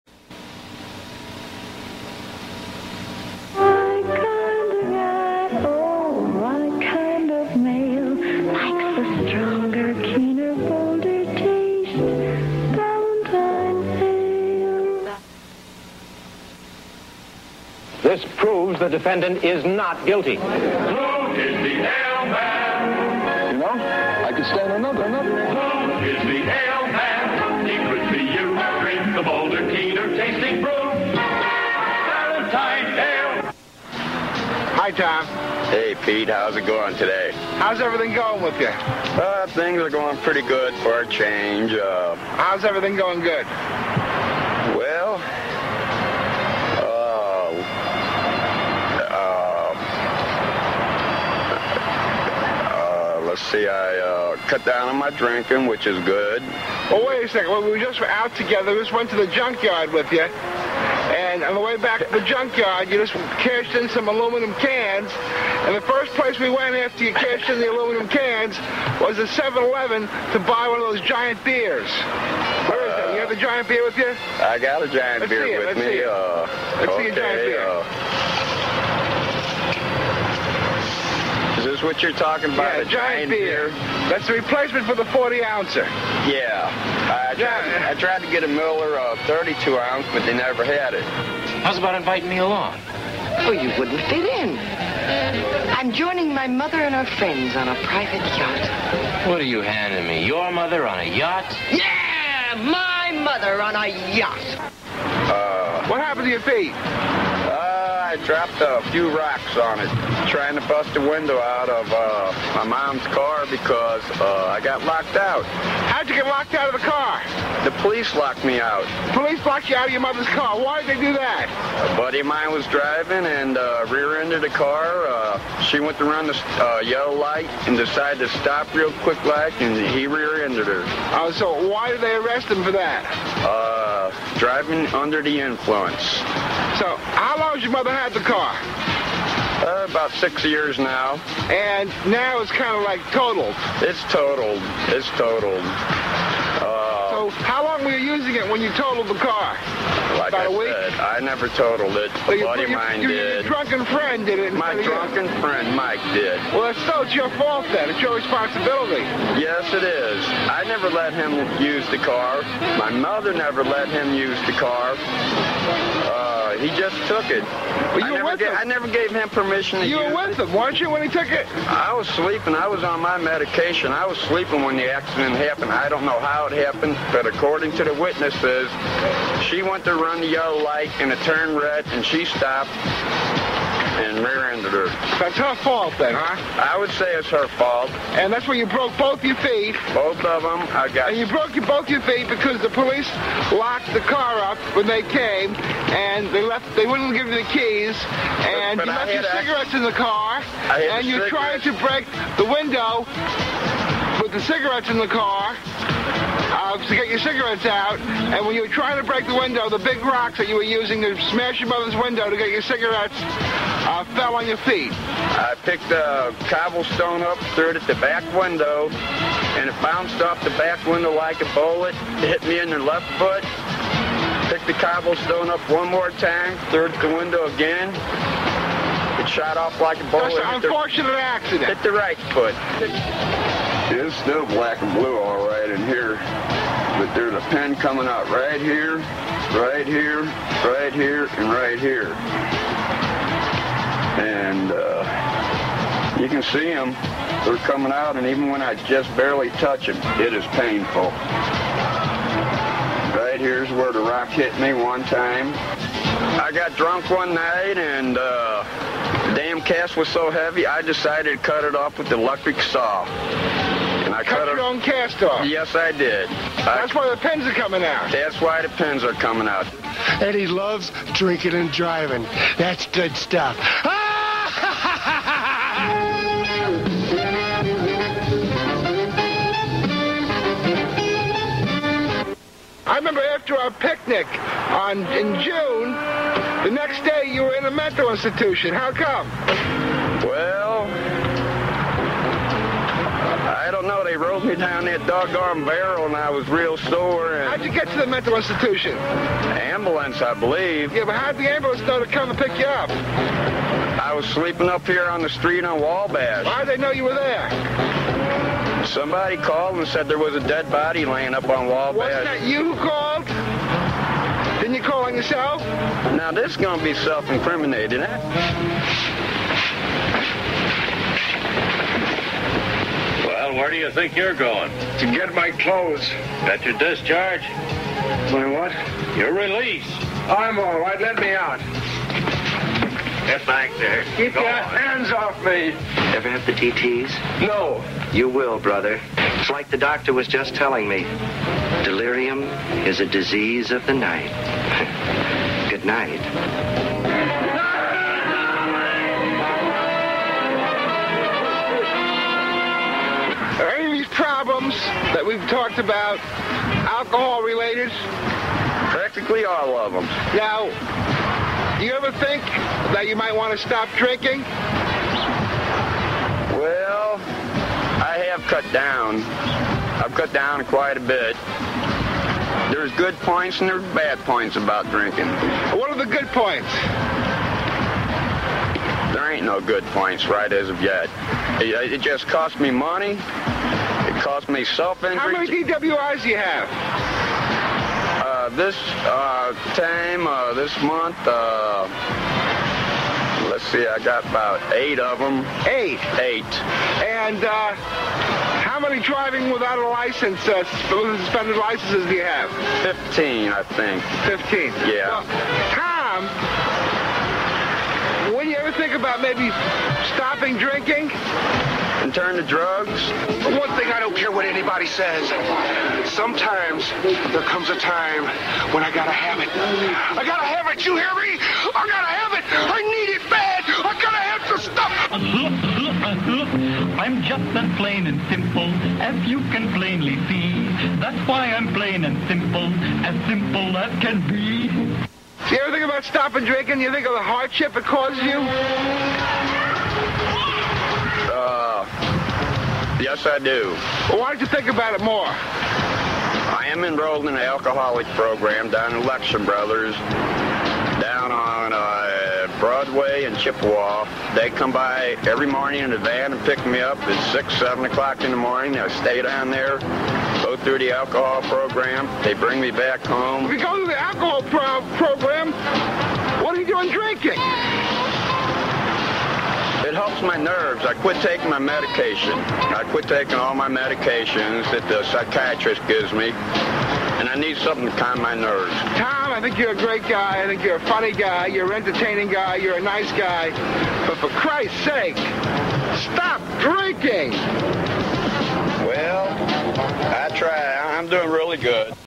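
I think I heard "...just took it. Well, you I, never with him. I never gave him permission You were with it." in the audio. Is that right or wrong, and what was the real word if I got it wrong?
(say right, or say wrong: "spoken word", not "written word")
right.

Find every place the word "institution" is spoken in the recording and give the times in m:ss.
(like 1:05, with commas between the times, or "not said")
4:48, 4:58.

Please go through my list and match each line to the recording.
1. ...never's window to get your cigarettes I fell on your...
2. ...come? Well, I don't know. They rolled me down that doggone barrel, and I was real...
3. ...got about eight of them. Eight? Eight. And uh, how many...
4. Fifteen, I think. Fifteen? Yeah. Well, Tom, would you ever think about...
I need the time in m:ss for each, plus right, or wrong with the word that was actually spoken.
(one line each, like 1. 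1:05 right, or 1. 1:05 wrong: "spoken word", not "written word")
1. 3:31 wrong: "mother", not "never"
2. 4:48 right
3. 6:33 right
4. 6:42 right.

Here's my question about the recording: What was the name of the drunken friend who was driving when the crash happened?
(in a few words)
Mike.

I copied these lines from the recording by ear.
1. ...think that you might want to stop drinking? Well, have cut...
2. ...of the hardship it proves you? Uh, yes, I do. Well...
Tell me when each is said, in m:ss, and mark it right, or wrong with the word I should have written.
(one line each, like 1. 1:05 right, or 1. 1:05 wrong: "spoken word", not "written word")
1. 6:02 right
2. 7:17 wrong: "causes", not "proves".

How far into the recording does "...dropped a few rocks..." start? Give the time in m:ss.
1:48.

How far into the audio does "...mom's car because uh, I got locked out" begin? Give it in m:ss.
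1:52.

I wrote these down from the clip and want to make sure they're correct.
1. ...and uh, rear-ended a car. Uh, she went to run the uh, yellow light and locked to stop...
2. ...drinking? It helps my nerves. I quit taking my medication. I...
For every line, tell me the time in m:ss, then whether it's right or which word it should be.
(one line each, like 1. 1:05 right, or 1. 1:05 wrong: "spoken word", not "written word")
1. 2:03 wrong: "decided", not "locked"
2. 7:46 right.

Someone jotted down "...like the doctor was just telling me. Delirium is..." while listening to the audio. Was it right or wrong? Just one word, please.
right.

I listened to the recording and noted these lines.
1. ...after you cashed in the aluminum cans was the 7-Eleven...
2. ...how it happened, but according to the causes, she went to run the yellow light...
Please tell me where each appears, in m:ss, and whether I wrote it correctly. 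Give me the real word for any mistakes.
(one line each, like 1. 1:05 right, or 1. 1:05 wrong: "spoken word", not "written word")
1. 1:06 right
2. 2:56 wrong: "witnesses", not "causes".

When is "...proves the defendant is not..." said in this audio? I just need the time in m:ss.
0:18.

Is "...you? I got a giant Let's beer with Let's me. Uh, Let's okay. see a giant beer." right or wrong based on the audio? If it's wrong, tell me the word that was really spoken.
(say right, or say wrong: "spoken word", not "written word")
right.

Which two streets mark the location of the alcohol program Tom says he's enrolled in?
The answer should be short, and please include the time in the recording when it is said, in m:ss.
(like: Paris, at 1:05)
Broadway and Chippewa, at 7:32.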